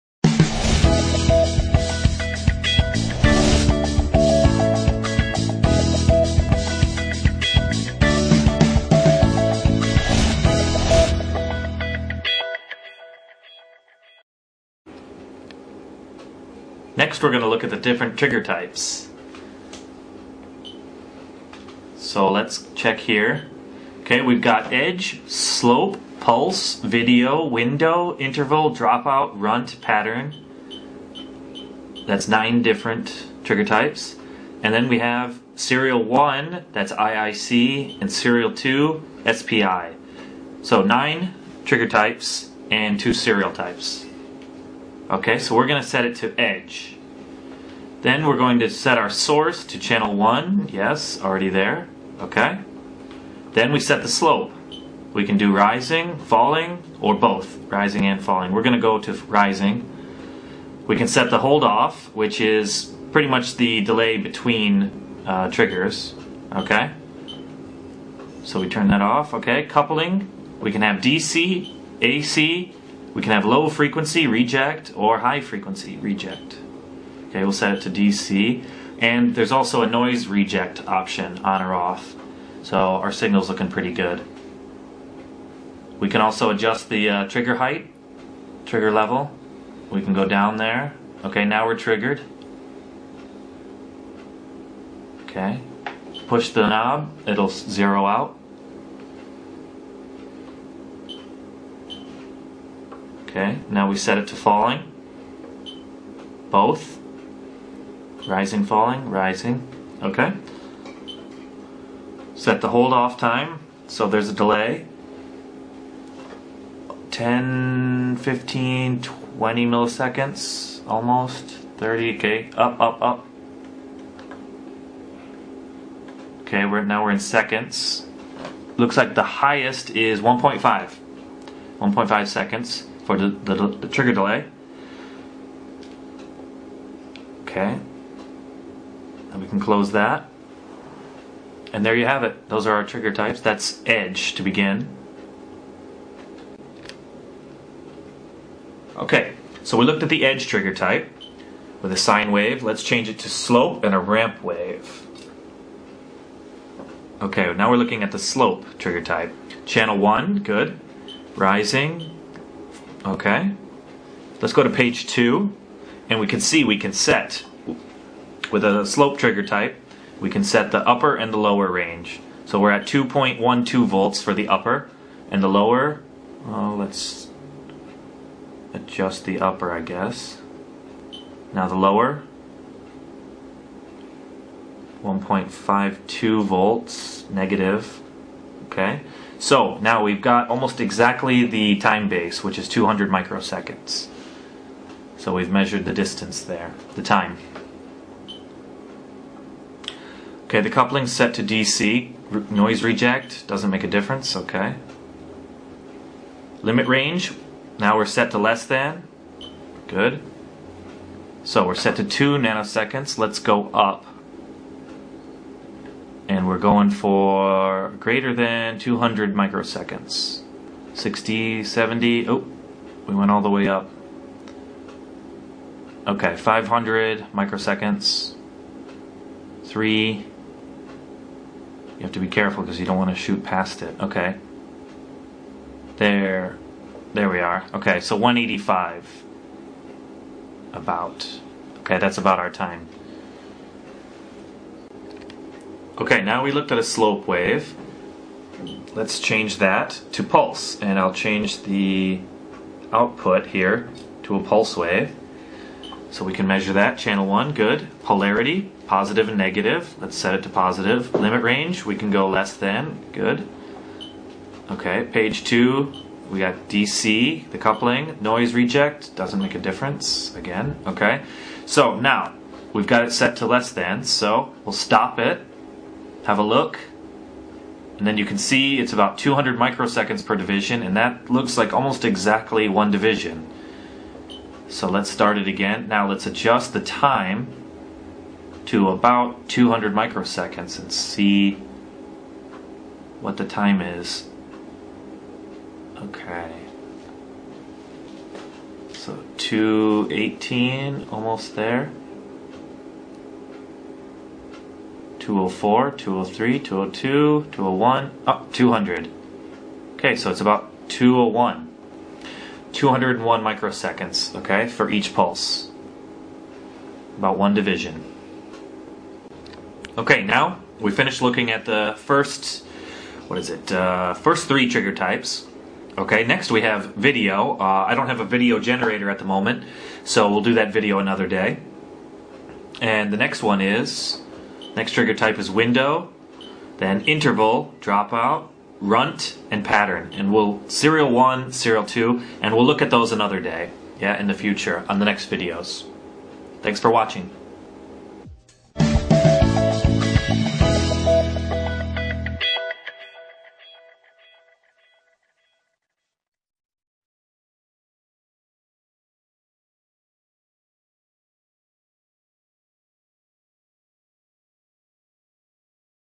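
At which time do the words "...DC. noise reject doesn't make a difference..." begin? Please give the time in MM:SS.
03:21.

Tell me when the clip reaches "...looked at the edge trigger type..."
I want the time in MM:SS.
02:29.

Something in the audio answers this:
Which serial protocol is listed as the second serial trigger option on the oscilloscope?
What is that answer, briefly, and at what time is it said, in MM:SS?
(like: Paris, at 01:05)
SPI, at 00:39.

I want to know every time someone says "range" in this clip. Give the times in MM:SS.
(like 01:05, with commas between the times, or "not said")
02:51, 03:26, 04:21.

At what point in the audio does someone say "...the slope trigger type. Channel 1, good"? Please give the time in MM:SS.
02:38.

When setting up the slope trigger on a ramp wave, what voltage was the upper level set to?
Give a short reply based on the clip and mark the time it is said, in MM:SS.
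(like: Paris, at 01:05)
2.12 volts, at 02:52.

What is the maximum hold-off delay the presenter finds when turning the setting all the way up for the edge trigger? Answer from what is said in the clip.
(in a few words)
1.5 seconds.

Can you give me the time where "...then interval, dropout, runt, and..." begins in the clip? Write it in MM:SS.
05:36.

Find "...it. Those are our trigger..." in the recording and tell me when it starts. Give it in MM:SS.
02:22.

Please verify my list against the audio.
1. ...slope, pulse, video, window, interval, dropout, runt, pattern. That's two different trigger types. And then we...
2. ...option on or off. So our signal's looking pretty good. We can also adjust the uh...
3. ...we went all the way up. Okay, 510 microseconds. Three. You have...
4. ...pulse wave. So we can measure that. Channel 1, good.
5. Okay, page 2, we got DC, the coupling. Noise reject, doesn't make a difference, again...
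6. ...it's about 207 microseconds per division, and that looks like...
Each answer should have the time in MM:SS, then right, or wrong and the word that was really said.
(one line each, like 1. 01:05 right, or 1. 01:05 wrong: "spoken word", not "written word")
1. 00:25 wrong: "nine", not "two"
2. 01:20 right
3. 03:43 wrong: "500", not "510"
4. 04:14 right
5. 04:24 right
6. 04:38 wrong: "200", not "207".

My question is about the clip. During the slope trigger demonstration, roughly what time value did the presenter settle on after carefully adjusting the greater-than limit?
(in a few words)
185.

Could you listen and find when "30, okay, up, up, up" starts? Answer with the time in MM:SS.
02:01.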